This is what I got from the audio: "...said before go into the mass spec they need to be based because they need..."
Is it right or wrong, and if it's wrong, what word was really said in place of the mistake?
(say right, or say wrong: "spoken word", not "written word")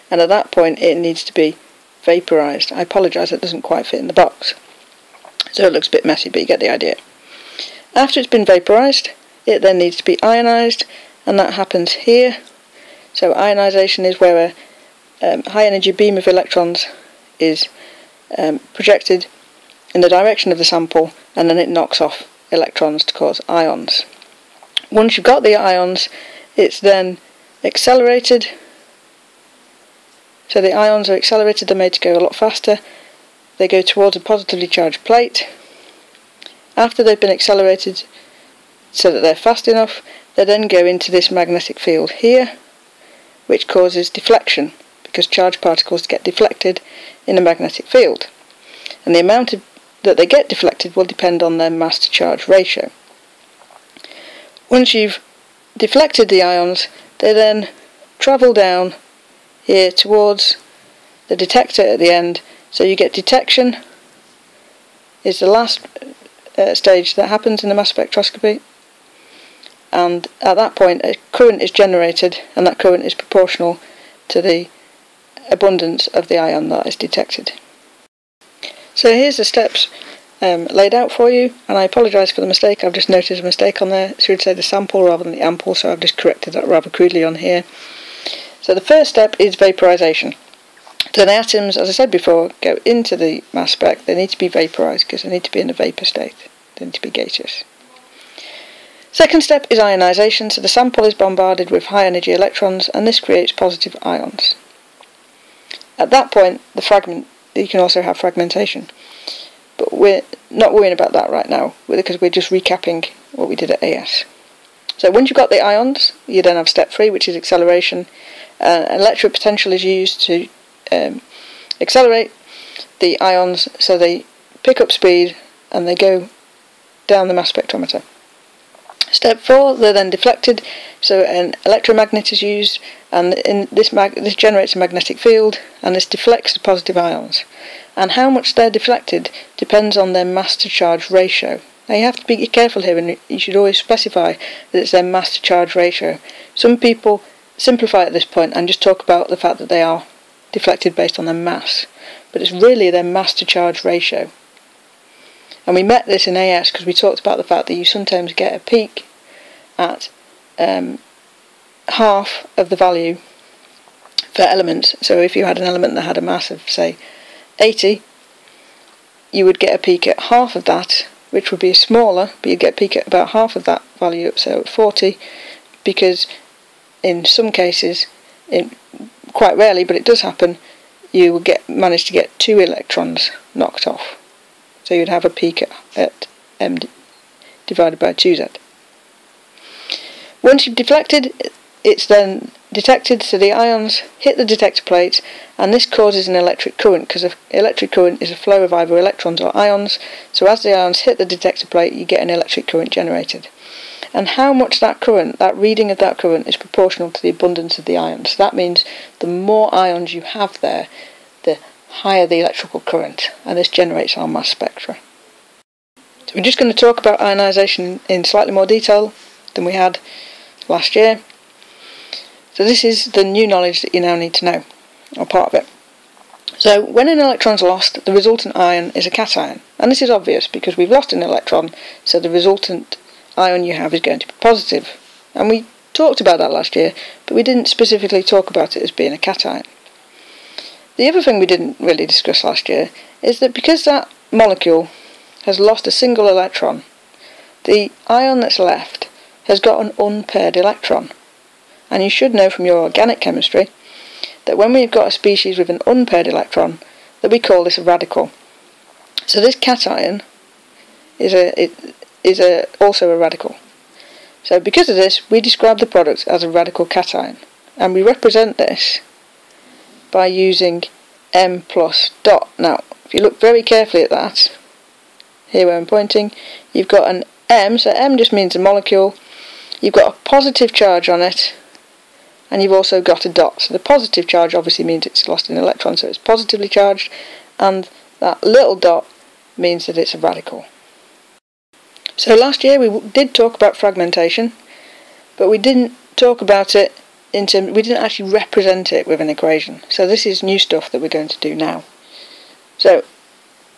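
wrong: "vaporized", not "based".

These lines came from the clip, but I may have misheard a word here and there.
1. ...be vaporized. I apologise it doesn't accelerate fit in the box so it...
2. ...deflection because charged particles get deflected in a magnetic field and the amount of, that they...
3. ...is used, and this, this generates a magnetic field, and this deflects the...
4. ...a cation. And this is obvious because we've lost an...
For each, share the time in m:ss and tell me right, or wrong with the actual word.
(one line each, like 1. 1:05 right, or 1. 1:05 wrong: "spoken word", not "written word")
1. 0:01 wrong: "quite", not "accelerate"
2. 0:44 right
3. 2:12 right
4. 3:49 right.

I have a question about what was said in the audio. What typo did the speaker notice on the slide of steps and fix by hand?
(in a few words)
ample.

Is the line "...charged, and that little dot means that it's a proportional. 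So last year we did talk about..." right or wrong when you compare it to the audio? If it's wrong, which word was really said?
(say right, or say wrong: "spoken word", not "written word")
wrong: "radical", not "proportional".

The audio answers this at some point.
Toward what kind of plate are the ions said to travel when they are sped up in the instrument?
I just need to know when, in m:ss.
0:34.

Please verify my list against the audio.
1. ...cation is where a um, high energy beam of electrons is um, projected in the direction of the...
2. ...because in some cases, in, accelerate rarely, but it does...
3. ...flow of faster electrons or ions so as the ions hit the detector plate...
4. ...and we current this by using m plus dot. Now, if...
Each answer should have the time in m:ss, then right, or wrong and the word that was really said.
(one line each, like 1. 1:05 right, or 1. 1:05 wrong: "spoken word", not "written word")
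1. 0:13 wrong: "ionization", not "cation"
2. 2:55 wrong: "quite", not "accelerate"
3. 3:18 wrong: "either", not "faster"
4. 4:27 wrong: "represent", not "current".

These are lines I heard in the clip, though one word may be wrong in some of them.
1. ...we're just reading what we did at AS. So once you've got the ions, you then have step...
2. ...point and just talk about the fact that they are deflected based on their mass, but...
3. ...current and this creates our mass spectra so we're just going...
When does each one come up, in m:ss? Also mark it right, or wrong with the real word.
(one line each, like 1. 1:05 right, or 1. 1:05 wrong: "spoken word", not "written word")
1. 1:52 wrong: "recapping", not "reading"
2. 2:28 right
3. 3:32 wrong: "generates", not "creates".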